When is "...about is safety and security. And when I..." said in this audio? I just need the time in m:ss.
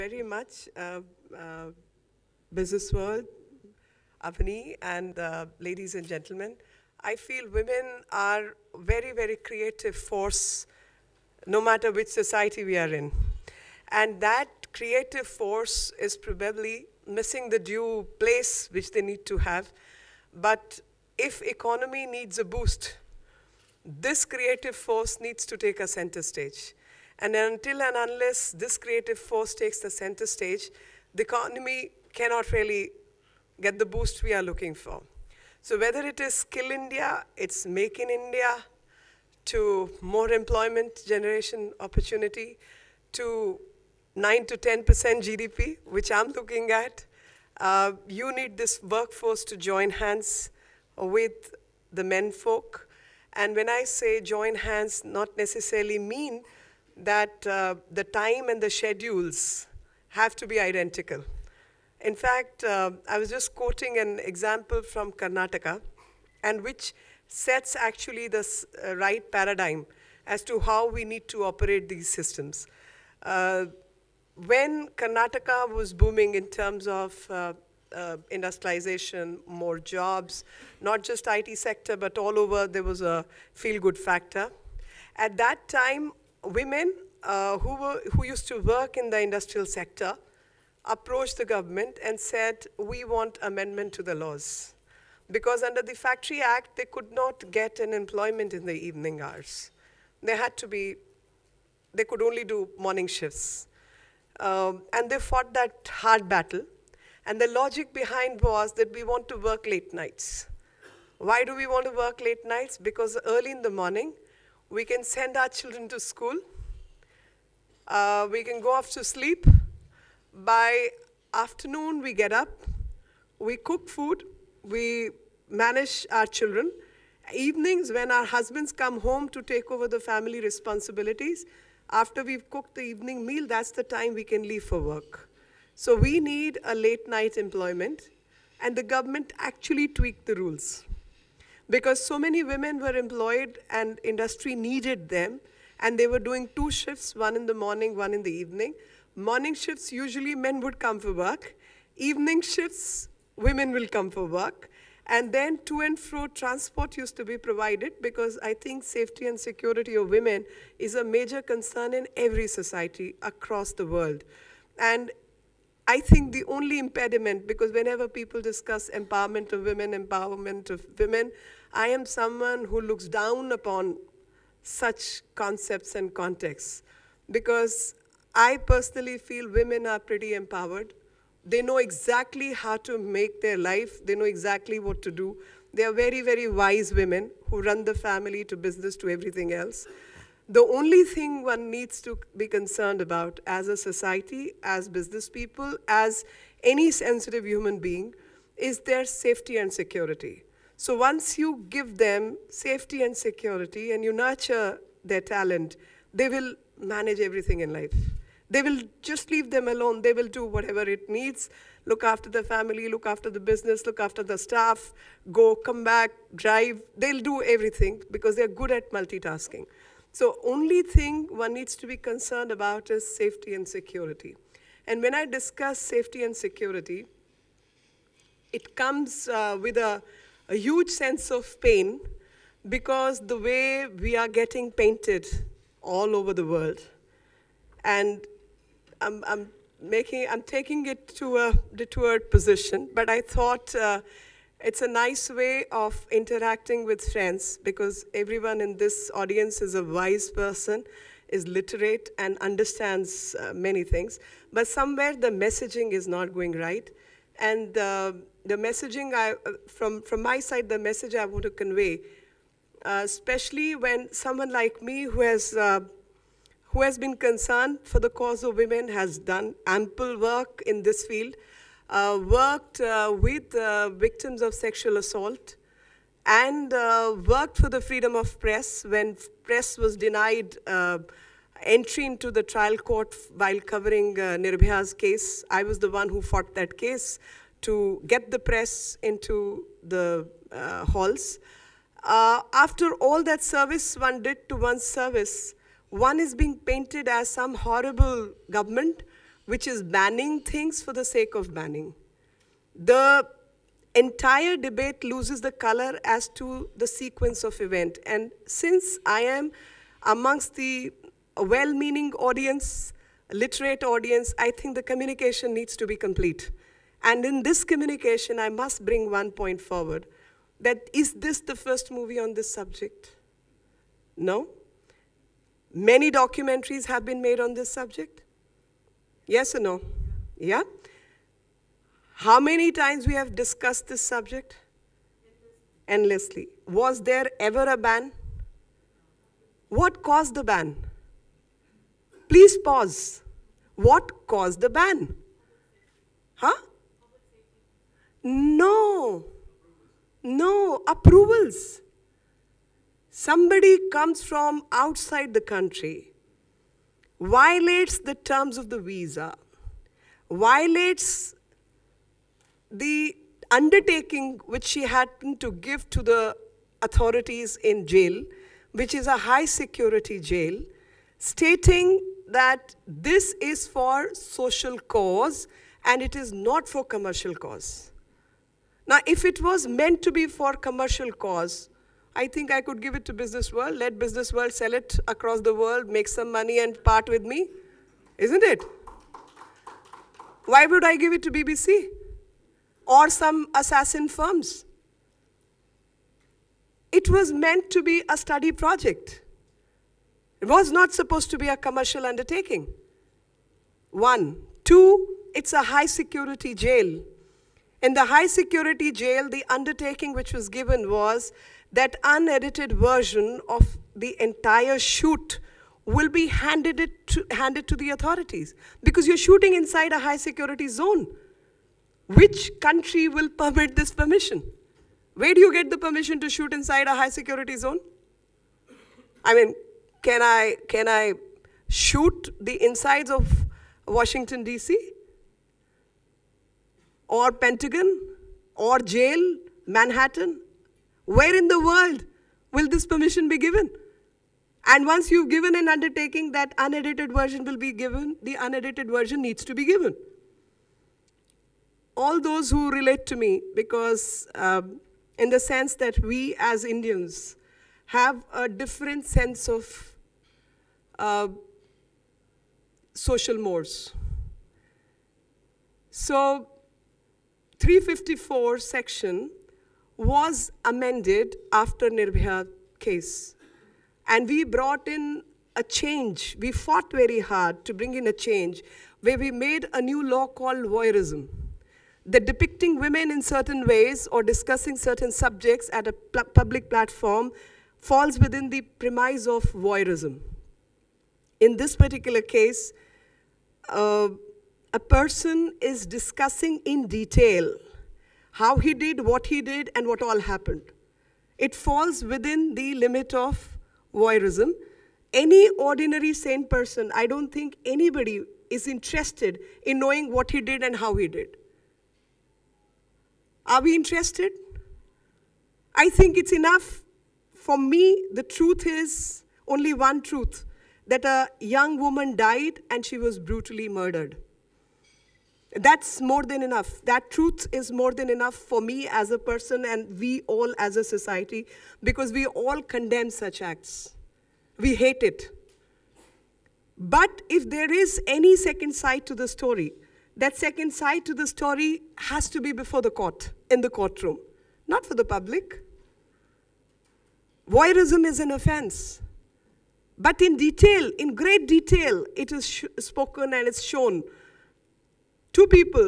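3:42.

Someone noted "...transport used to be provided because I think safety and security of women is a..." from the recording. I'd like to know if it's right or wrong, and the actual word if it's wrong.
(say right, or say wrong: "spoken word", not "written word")
right.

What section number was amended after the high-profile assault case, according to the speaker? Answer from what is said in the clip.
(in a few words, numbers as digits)
354.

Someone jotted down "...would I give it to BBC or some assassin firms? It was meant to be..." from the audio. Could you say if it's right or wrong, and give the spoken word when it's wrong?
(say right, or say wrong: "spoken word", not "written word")
right.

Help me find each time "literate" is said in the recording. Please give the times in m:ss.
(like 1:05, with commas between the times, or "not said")
4:11, 5:13.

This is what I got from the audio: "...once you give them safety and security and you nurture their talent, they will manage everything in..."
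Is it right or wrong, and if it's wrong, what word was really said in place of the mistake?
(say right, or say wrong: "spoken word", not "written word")
right.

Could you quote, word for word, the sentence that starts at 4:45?
I was the one who fought that case to get the press into the uh, halls.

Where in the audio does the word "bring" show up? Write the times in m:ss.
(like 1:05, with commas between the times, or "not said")
5:18, 7:57.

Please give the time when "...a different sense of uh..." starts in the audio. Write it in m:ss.
7:38.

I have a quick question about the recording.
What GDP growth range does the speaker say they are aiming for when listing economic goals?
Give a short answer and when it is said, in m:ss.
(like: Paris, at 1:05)
9 to 10%, at 0:44.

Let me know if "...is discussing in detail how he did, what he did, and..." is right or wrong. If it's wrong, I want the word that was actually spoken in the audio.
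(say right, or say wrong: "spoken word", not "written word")
right.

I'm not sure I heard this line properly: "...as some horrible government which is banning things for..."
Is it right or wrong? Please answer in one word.
right.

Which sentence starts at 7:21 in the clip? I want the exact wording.
Where in the world will this permission be given?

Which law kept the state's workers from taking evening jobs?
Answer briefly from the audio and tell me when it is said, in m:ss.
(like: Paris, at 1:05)
Factory Act, at 1:35.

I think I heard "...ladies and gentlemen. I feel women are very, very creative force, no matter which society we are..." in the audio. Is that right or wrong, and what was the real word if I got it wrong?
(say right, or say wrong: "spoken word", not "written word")
right.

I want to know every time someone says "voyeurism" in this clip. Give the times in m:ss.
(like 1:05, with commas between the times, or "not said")
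8:00, 8:09, 8:23, 9:07.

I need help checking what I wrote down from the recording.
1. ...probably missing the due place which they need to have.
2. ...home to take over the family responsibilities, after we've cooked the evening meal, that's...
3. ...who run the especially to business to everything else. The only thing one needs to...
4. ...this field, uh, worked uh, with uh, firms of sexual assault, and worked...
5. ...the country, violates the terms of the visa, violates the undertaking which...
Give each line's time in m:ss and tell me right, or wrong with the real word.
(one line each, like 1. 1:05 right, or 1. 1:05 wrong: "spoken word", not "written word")
1. 0:16 right
2. 2:08 right
3. 3:07 wrong: "family", not "especially"
4. 4:30 wrong: "victims", not "firms"
5. 5:55 right.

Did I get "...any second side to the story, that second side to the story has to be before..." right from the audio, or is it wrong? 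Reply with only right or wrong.
right.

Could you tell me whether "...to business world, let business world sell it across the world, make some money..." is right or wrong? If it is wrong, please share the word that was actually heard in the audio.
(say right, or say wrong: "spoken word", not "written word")
right.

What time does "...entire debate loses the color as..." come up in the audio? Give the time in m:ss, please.
5:03.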